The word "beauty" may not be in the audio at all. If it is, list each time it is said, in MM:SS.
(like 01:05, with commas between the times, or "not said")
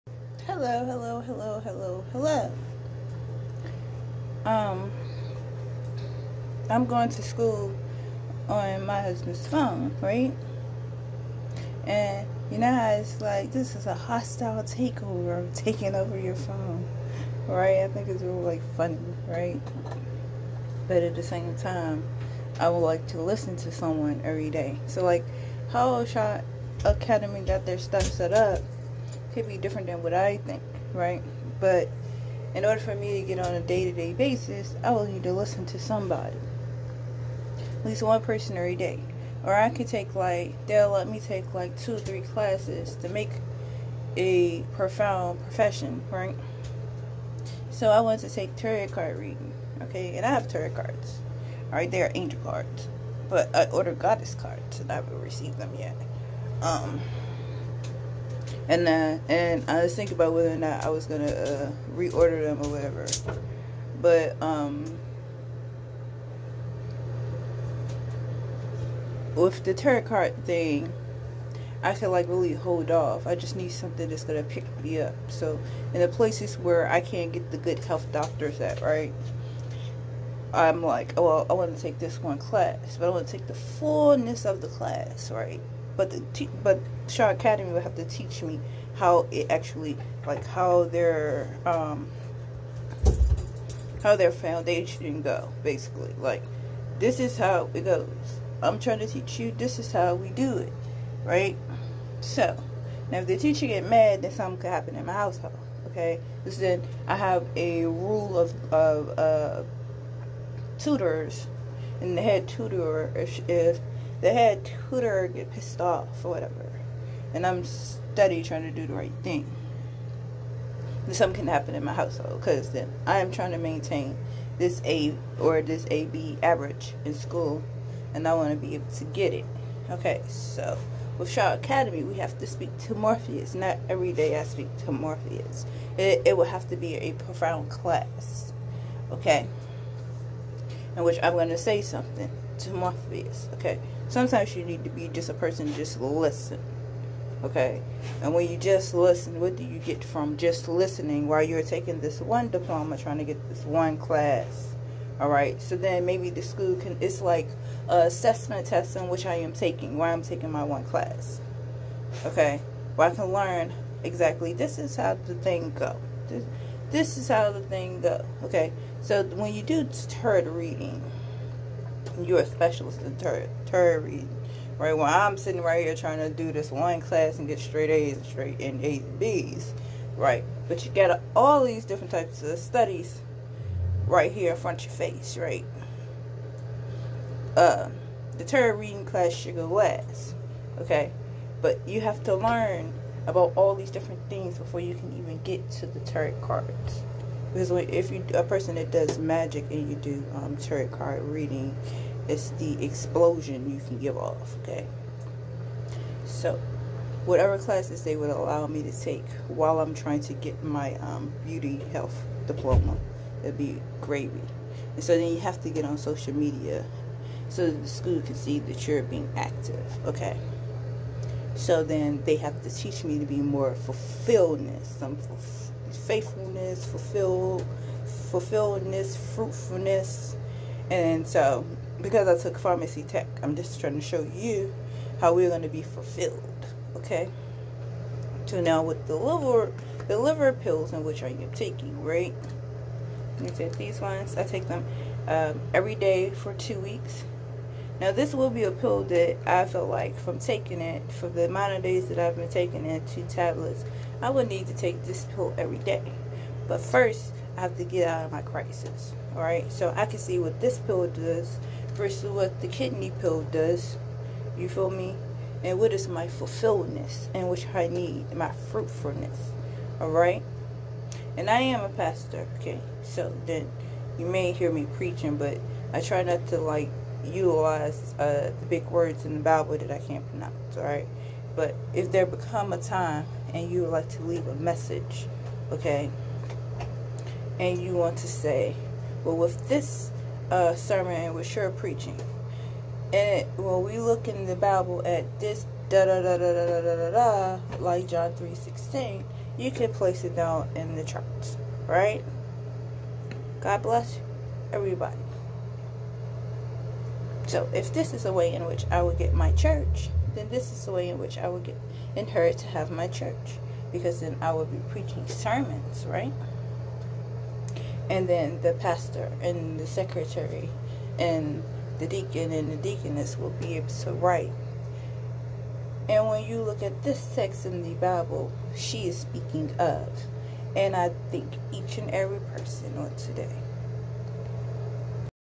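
03:31.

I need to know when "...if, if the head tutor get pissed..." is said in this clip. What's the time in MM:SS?
01:53.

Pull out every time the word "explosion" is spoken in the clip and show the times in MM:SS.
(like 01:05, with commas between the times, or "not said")
03:22.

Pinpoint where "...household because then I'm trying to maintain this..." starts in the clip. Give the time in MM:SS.
02:01.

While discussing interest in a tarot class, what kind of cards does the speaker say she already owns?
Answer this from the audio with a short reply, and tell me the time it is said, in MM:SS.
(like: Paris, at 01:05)
Angel cards, at 00:52.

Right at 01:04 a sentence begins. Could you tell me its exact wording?
But um, with the tarot card thing, I could like really hold off.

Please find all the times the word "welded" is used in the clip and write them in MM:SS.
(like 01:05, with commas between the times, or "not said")
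not said.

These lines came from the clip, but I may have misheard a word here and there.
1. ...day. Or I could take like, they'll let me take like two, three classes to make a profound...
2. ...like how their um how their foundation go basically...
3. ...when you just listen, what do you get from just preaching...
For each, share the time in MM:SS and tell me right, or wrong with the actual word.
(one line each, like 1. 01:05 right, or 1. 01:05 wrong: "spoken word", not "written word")
1. 00:38 right
2. 01:30 right
3. 02:28 wrong: "listening", not "preaching".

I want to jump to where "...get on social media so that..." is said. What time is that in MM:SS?
03:35.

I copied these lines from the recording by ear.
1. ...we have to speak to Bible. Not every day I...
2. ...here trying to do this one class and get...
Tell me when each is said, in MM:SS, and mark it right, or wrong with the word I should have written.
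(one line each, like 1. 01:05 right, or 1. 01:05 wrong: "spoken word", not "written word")
1. 02:12 wrong: "Morpheus", not "Bible"
2. 02:55 right.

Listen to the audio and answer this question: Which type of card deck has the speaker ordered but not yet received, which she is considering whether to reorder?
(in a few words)
Goddess cards.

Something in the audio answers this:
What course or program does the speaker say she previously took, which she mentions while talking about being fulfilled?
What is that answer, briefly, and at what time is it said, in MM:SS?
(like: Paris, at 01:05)
Pharmacy tech, at 03:52.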